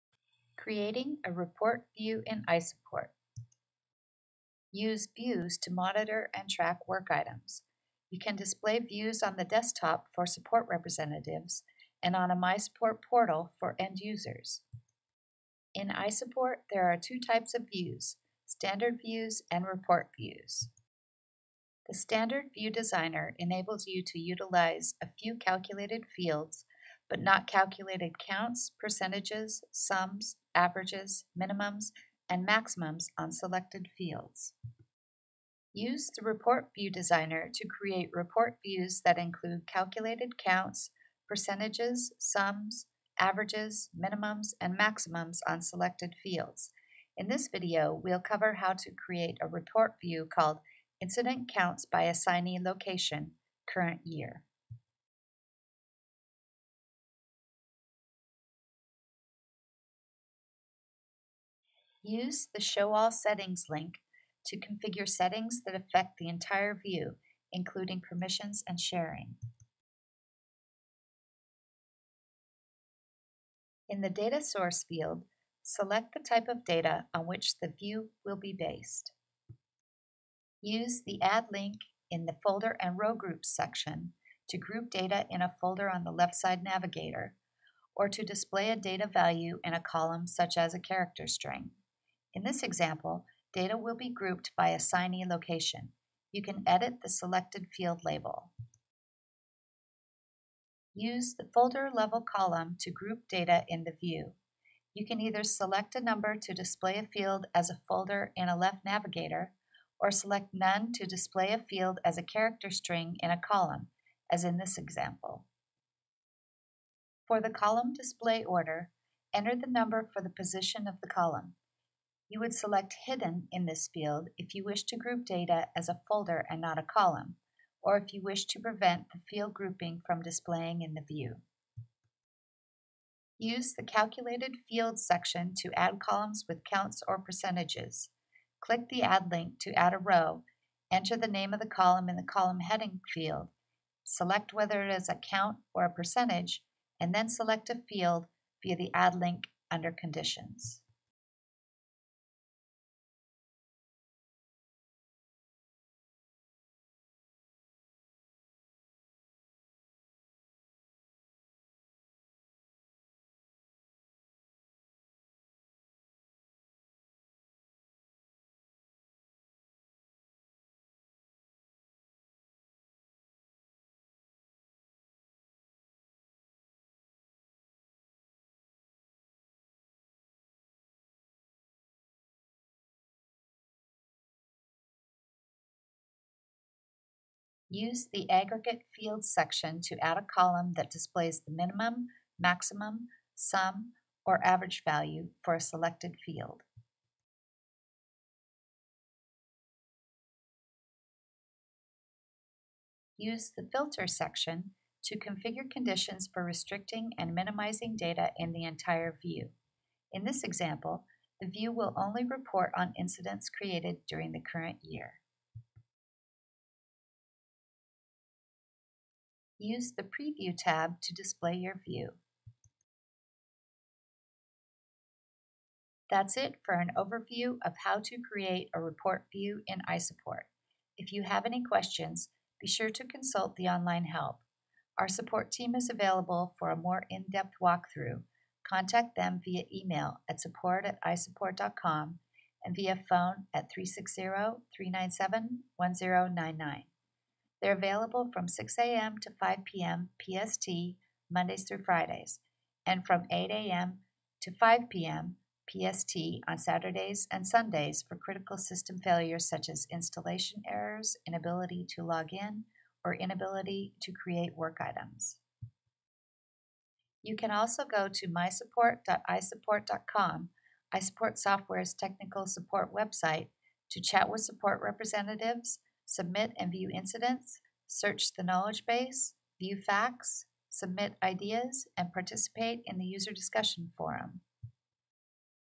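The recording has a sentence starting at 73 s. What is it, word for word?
In the Data Source field, select the type of data on which the view will be based.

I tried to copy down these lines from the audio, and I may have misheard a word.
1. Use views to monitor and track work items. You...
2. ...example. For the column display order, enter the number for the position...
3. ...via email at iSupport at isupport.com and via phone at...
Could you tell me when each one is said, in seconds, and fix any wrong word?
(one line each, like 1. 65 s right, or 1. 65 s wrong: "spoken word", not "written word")
1. 4 s right
2. 114 s right
3. 239 s wrong: "support", not "iSupport".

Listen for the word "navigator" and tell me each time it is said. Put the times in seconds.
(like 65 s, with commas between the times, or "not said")
86 s, 108 s.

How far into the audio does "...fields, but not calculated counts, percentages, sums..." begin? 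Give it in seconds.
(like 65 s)
26 s.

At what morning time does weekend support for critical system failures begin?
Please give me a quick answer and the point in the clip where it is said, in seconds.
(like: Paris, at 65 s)
8 a.m., at 253 s.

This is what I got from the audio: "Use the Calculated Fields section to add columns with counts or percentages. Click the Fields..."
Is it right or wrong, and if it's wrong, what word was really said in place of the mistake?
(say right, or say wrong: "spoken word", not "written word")
wrong: "Add", not "Fields".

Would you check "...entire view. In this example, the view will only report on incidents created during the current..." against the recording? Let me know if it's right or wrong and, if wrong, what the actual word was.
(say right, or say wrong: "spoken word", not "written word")
right.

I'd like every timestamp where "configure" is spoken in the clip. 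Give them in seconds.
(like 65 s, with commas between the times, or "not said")
64 s, 205 s.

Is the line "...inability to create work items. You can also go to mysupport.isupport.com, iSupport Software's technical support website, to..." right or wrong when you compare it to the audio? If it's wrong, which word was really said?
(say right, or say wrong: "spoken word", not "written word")
right.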